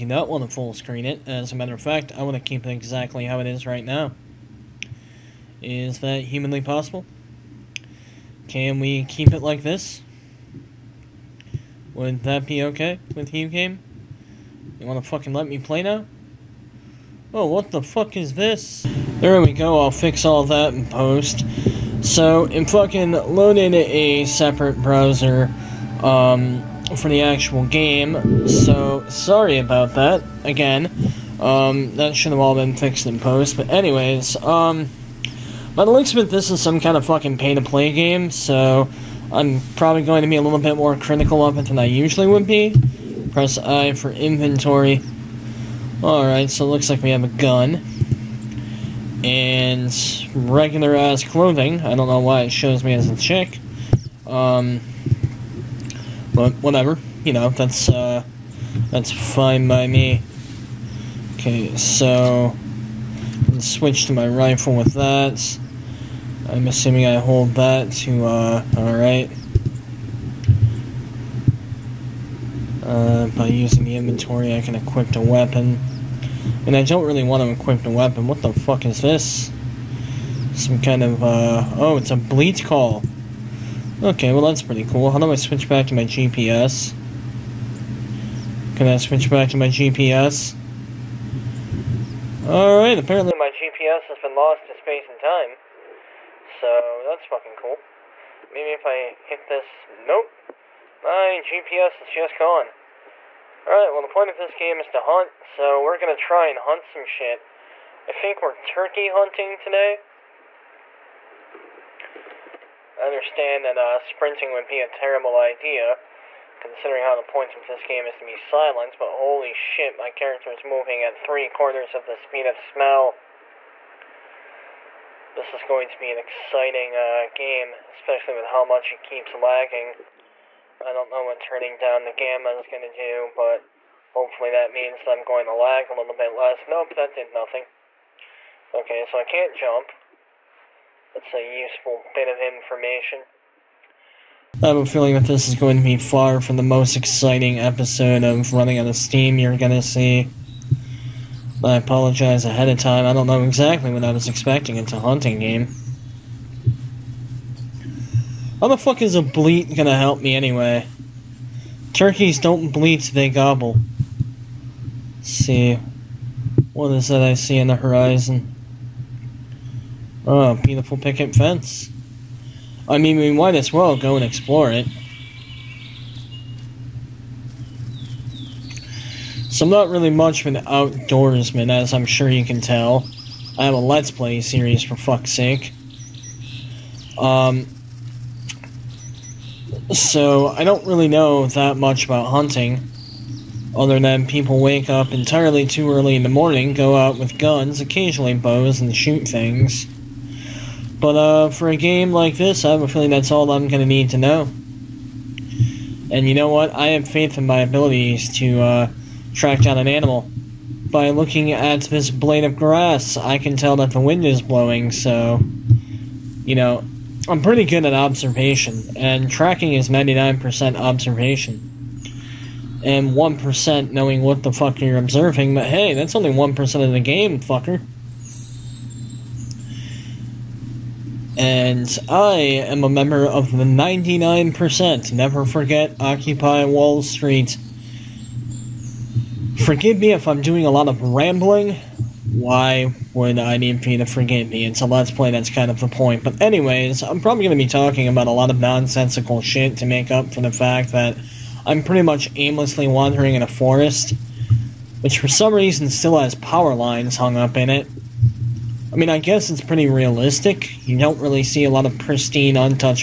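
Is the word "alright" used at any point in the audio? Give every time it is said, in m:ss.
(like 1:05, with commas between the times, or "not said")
0:46, 1:08, 1:32, 1:43.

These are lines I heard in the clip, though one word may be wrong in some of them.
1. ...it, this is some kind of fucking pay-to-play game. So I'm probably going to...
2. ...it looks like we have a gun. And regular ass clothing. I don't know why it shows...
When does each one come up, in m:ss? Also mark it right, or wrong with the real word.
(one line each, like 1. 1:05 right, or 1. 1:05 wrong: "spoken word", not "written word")
1. 0:36 right
2. 0:46 right.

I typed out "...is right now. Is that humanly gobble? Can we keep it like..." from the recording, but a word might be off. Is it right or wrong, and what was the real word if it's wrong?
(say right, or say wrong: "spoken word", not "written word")
wrong: "possible", not "gobble".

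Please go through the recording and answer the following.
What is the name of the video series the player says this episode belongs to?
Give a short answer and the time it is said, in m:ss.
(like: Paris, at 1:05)
Running Out of Steam, at 2:28.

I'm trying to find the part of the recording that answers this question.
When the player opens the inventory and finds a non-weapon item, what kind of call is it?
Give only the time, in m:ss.
1:22.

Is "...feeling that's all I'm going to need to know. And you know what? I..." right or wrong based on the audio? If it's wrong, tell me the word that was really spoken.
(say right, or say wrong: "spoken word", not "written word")
right.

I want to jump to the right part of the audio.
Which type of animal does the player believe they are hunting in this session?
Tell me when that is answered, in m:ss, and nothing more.
1:48.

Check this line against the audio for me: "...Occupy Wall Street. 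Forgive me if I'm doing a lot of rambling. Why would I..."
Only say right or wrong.
right.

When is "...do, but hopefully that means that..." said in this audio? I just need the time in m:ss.
2:12.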